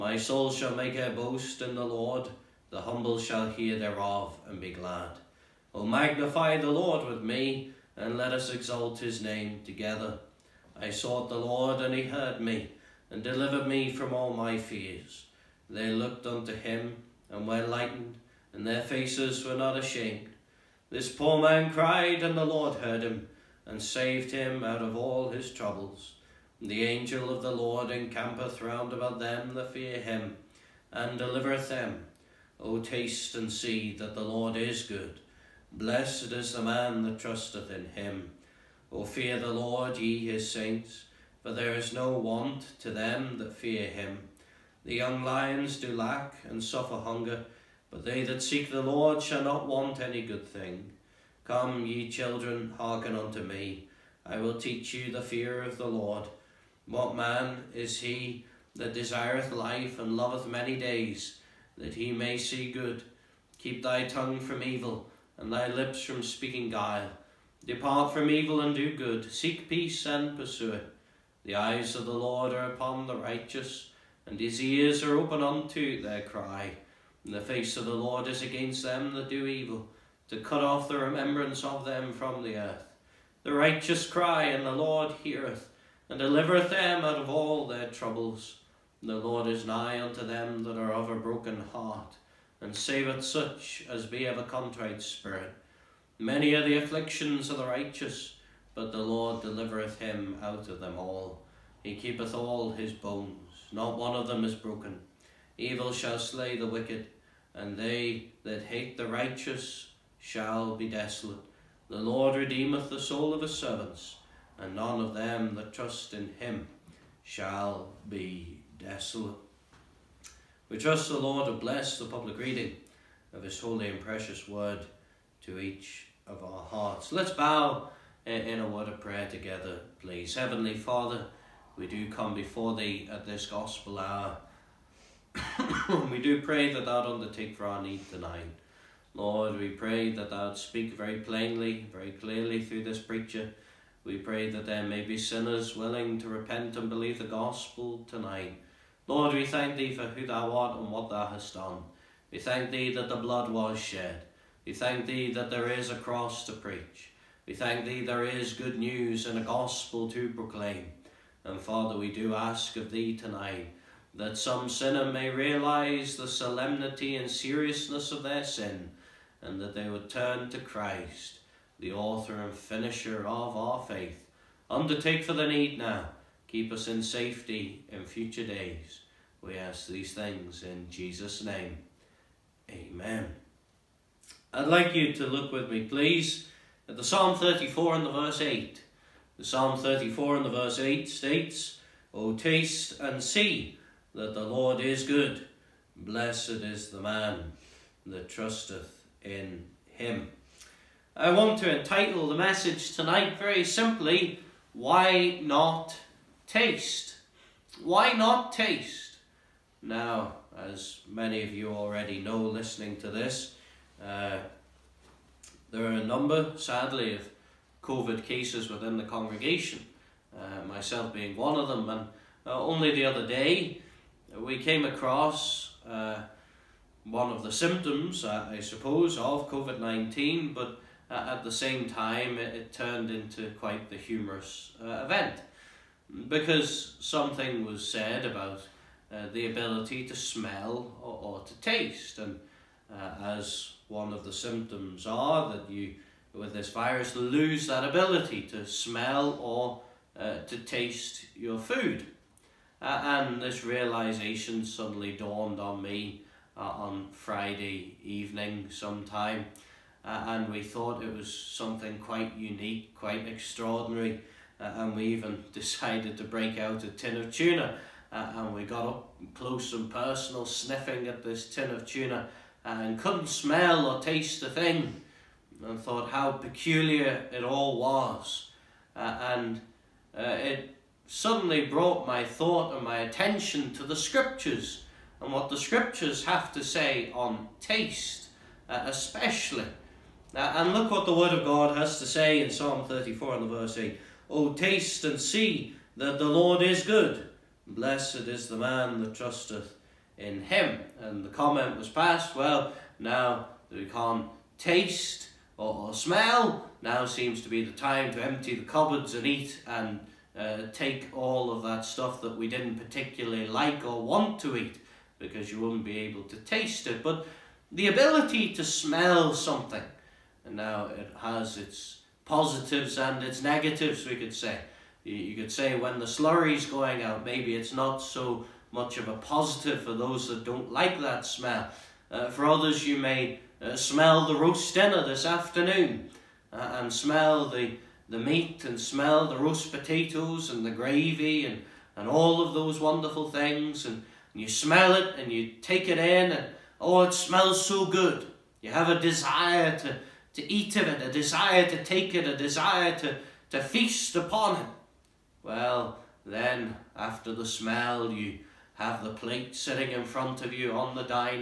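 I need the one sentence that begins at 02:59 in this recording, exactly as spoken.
We ask these things in Jesus' name.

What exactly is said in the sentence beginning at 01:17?
And the face of the Lord is against them that do evil, to cut off the remembrance of them from the earth.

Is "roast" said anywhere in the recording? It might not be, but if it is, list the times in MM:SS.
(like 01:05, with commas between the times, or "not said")
05:34, 05:39.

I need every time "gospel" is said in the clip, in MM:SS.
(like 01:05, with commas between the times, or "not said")
02:13, 02:27, 02:39.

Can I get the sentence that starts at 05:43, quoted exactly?
And, and you smell it and you take it in and, oh, it smells so good.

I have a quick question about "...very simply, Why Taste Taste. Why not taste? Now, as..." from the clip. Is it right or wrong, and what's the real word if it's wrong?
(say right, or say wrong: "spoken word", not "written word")
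wrong: "Not", not "Taste".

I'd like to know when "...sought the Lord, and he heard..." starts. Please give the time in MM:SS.
00:10.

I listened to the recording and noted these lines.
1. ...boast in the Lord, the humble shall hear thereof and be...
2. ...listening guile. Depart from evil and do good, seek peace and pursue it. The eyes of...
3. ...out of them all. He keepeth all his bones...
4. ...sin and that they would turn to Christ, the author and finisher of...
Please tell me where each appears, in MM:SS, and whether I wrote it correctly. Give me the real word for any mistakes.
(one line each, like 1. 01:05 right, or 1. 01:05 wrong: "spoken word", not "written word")
1. 00:01 right
2. 01:06 wrong: "speaking", not "listening"
3. 01:40 right
4. 02:48 right.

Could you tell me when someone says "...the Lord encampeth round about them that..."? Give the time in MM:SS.
00:27.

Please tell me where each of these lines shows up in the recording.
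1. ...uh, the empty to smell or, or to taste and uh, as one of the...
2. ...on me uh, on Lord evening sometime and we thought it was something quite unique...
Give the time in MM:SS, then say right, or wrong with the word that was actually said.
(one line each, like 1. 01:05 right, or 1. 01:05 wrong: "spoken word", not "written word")
1. 03:59 wrong: "ability", not "empty"
2. 04:15 wrong: "Friday", not "Lord".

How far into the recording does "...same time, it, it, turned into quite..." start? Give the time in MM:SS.
03:51.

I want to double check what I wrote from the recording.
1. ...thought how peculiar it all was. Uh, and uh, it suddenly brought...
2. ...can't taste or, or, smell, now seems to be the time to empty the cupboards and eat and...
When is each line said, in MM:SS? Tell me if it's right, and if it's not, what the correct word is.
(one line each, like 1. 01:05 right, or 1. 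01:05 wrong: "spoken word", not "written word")
1. 04:35 right
2. 05:03 right.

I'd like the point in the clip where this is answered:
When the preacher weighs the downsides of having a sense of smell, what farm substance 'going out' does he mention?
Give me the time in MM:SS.
05:26.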